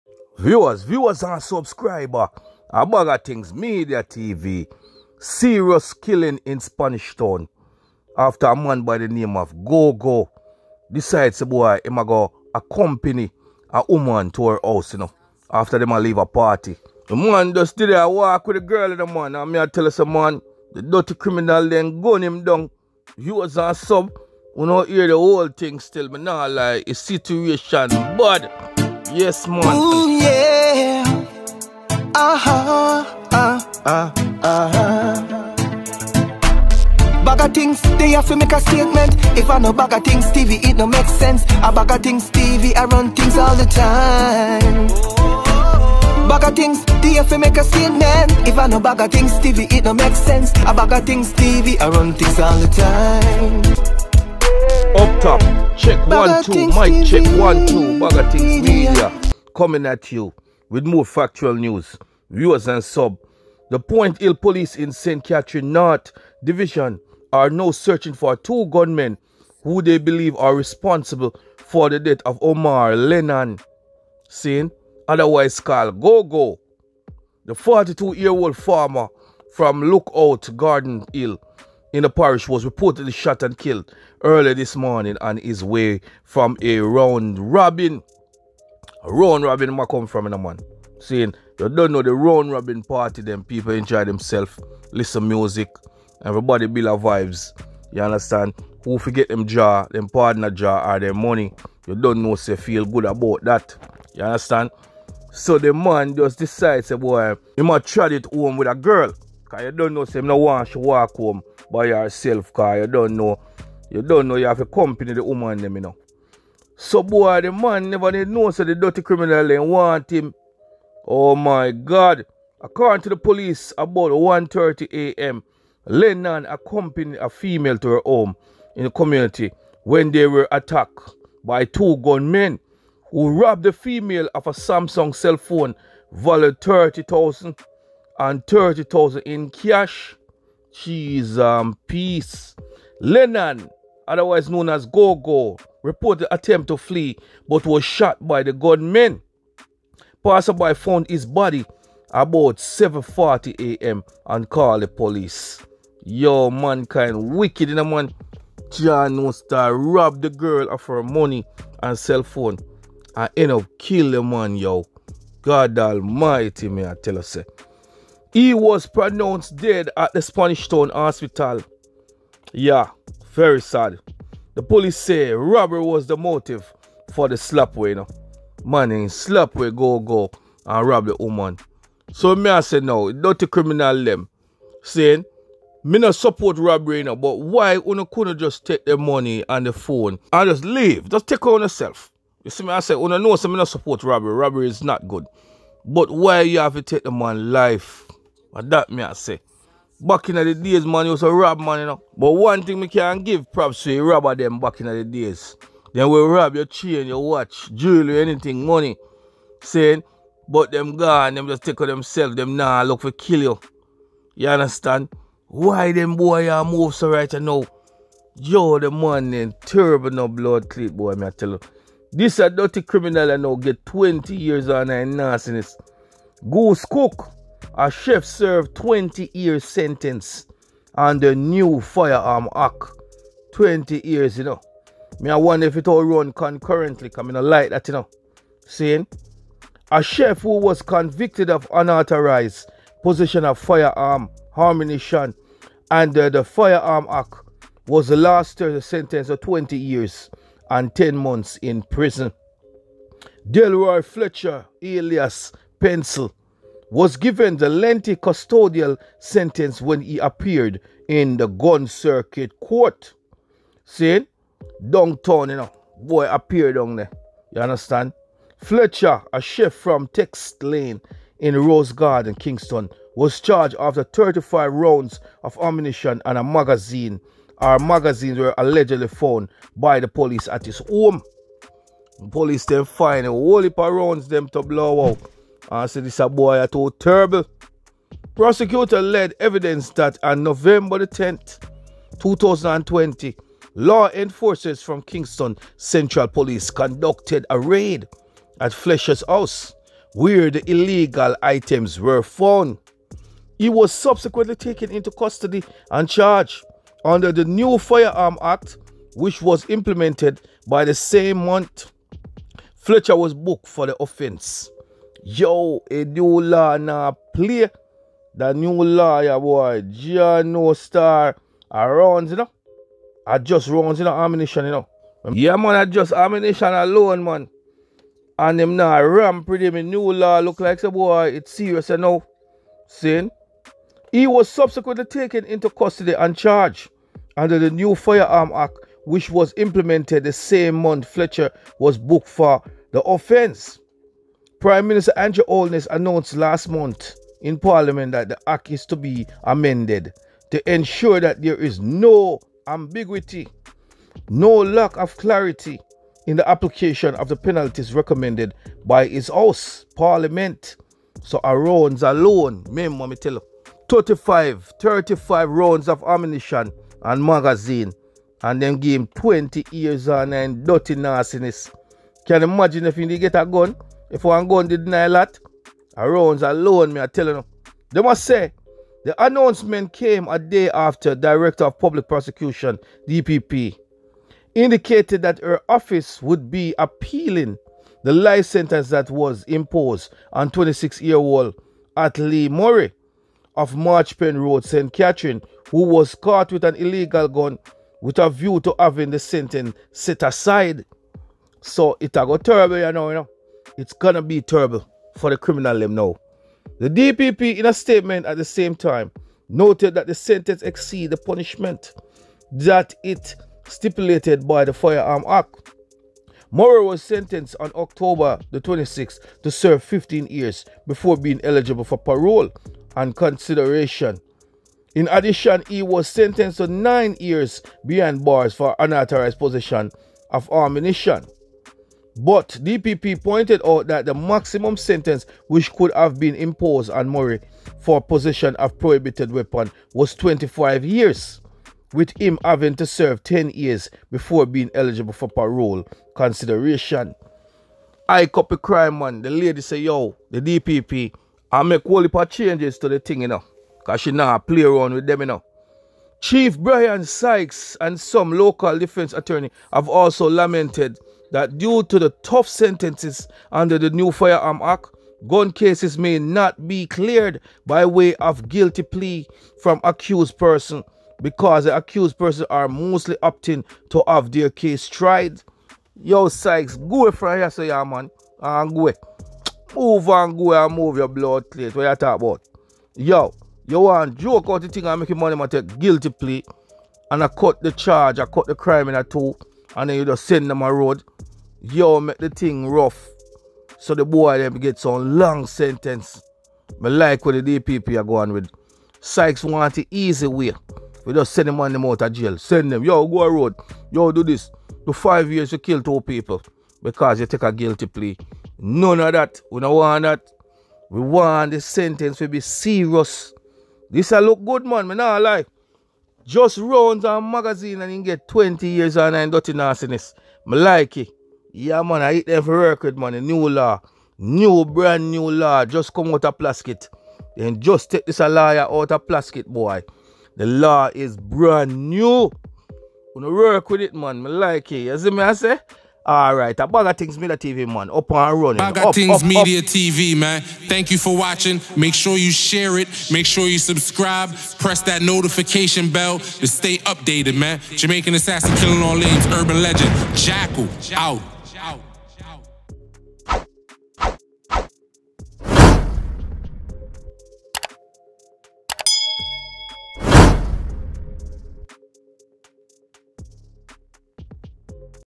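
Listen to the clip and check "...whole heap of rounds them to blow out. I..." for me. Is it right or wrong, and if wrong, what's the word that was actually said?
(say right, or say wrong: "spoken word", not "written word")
right.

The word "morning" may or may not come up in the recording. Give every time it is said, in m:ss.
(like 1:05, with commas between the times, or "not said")
1:24.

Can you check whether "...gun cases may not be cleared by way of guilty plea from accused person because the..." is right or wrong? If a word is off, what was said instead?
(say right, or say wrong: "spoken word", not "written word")
right.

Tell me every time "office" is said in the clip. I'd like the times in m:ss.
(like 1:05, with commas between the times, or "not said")
6:25.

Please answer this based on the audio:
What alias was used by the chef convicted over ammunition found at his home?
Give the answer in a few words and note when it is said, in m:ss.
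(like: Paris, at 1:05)
Pencil, at 4:15.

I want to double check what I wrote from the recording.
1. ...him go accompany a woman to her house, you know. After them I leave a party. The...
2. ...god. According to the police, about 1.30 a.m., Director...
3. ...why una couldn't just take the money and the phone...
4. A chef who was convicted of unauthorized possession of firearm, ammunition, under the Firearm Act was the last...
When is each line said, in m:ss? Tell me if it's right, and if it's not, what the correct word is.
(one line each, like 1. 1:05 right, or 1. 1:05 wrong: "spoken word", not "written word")
1. 0:11 right
2. 2:01 wrong: "Lennon", not "Director"
3. 3:07 right
4. 3:59 right.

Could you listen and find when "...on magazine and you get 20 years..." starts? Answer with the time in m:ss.
8:37.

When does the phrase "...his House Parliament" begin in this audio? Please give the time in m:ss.
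5:59.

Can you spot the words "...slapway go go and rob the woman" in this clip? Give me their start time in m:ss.
2:59.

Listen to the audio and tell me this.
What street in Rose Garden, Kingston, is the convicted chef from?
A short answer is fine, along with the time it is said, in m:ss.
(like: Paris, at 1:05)
Tex Lane, at 4:30.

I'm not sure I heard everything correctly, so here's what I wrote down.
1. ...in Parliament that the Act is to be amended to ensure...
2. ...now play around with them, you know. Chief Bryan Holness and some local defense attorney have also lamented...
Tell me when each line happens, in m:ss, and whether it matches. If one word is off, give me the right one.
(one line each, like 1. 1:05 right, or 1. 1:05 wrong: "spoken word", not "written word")
1. 5:47 right
2. 7:34 wrong: "Sykes", not "Holness".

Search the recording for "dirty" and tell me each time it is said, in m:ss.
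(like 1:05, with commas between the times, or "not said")
0:20, 1:58, 3:42, 6:10.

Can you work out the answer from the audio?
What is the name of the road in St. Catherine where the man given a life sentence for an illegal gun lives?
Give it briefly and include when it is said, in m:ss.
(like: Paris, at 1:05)
Marchpen Road, at 6:33.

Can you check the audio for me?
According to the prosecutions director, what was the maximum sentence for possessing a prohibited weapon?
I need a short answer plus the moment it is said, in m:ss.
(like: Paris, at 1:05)
25 years, at 7:20.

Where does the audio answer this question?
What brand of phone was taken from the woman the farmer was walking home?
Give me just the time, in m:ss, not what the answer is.
2:14.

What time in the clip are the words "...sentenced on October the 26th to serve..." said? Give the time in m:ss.
6:57.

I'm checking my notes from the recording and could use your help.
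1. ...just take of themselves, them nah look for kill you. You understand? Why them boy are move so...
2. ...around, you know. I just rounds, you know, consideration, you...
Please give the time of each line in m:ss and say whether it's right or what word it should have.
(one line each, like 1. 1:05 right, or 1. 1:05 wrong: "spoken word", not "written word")
1. 3:31 right
2. 5:21 wrong: "ammunition", not "consideration".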